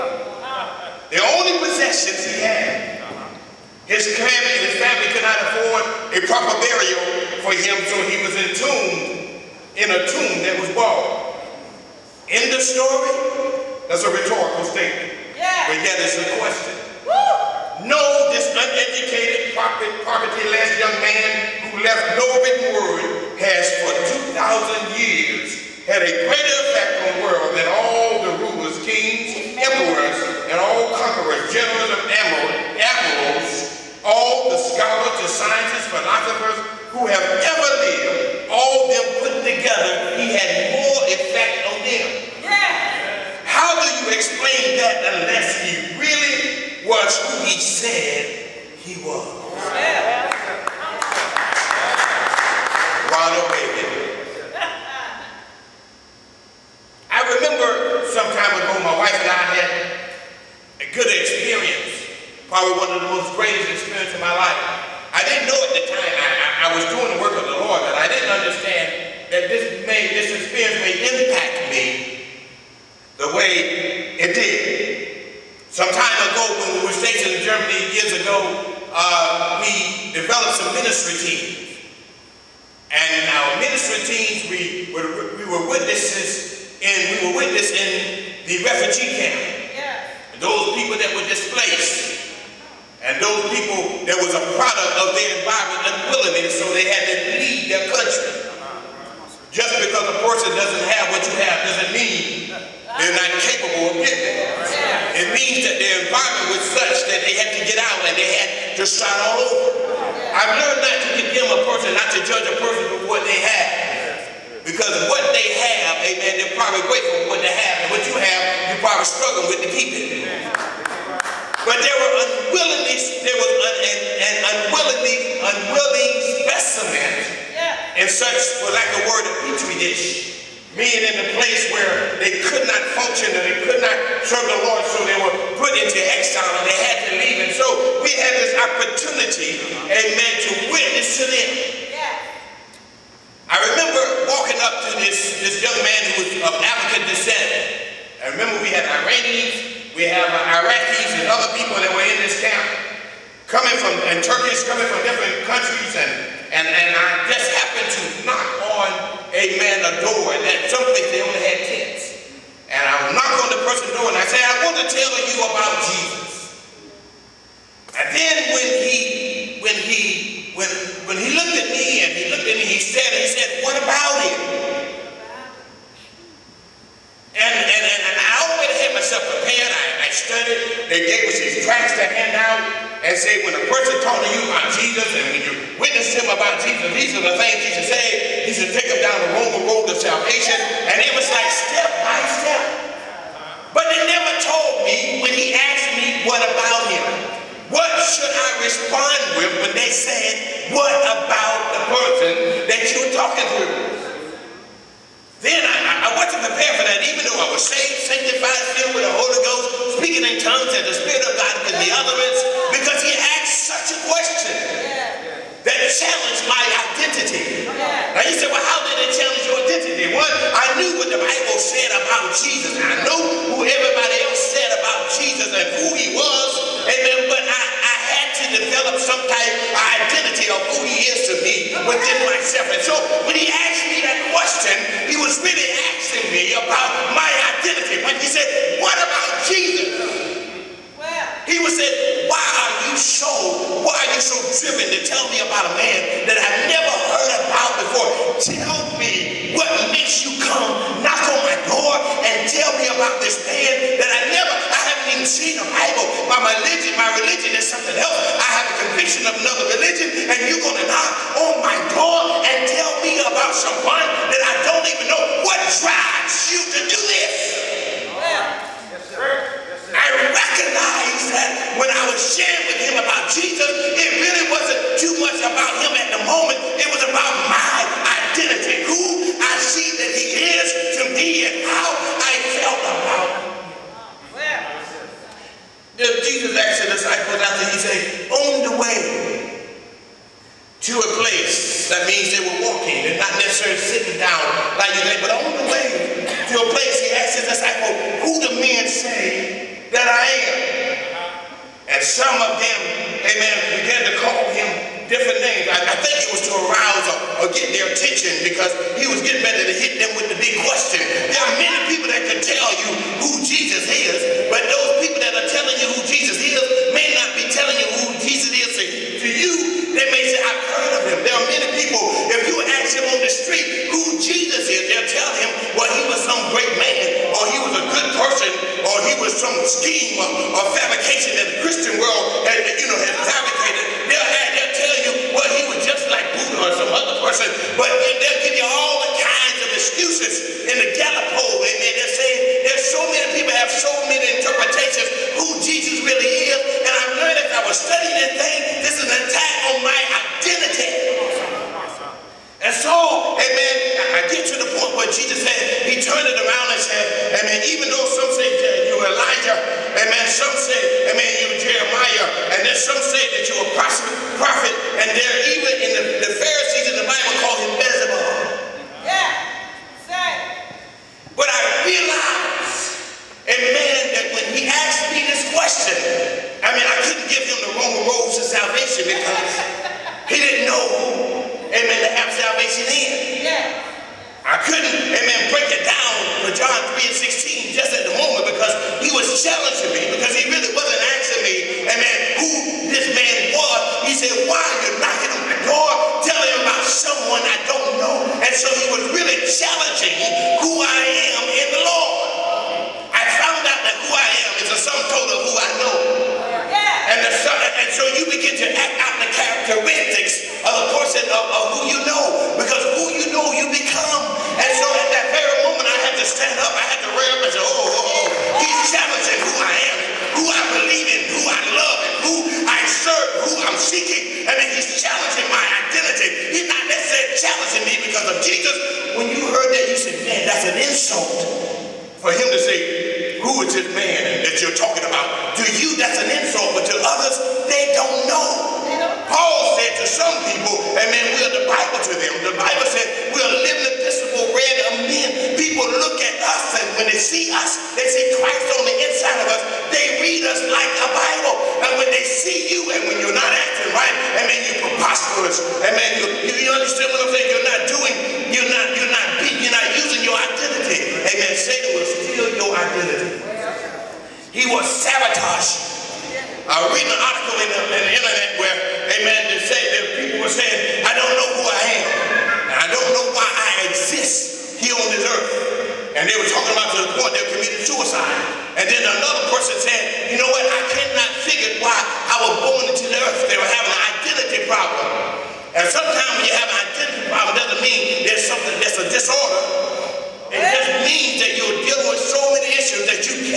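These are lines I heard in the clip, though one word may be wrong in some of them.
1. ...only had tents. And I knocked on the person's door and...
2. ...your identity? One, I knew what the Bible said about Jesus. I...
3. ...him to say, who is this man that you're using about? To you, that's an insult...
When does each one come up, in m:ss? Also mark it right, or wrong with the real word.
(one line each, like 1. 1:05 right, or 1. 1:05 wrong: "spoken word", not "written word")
1. 2:41 right
2. 3:39 right
3. 7:12 wrong: "talking", not "using".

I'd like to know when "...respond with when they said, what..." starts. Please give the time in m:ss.
3:18.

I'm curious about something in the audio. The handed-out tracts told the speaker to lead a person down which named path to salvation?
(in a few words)
the Roman road.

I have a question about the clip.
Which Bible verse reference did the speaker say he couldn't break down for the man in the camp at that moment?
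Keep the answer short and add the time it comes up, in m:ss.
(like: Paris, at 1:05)
John 3:16, at 6:26.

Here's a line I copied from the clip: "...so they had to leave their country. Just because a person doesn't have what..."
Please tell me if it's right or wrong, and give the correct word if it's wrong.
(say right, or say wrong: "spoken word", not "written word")
right.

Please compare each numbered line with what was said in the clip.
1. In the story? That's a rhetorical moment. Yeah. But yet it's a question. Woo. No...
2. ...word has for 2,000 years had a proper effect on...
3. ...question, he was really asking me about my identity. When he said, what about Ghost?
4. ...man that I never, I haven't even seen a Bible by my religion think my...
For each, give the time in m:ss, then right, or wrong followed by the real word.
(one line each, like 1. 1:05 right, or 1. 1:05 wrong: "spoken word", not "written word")
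1. 0:12 wrong: "statement", not "moment"
2. 0:22 wrong: "greater", not "proper"
3. 3:54 wrong: "Jesus", not "Ghost"
4. 4:13 right.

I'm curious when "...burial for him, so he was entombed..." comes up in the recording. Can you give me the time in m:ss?
0:06.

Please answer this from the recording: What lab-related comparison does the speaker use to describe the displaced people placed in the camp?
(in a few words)
a petri dish.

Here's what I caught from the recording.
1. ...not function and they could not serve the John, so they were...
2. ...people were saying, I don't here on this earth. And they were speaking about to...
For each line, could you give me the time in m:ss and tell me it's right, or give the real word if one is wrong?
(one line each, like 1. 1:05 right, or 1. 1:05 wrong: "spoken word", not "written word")
1. 2:12 wrong: "Lord", not "John"
2. 7:50 wrong: "talking", not "speaking".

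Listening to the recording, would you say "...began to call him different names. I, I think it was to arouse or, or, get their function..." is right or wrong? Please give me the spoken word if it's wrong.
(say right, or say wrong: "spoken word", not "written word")
wrong: "attention", not "function".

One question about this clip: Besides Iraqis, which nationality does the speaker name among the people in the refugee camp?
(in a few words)
Turkish.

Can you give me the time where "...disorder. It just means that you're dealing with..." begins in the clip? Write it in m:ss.
8:09.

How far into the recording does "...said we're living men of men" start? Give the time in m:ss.
7:22.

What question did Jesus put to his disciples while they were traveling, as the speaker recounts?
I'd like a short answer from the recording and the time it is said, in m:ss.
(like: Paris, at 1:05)
who do men say that I am?, at 4:58.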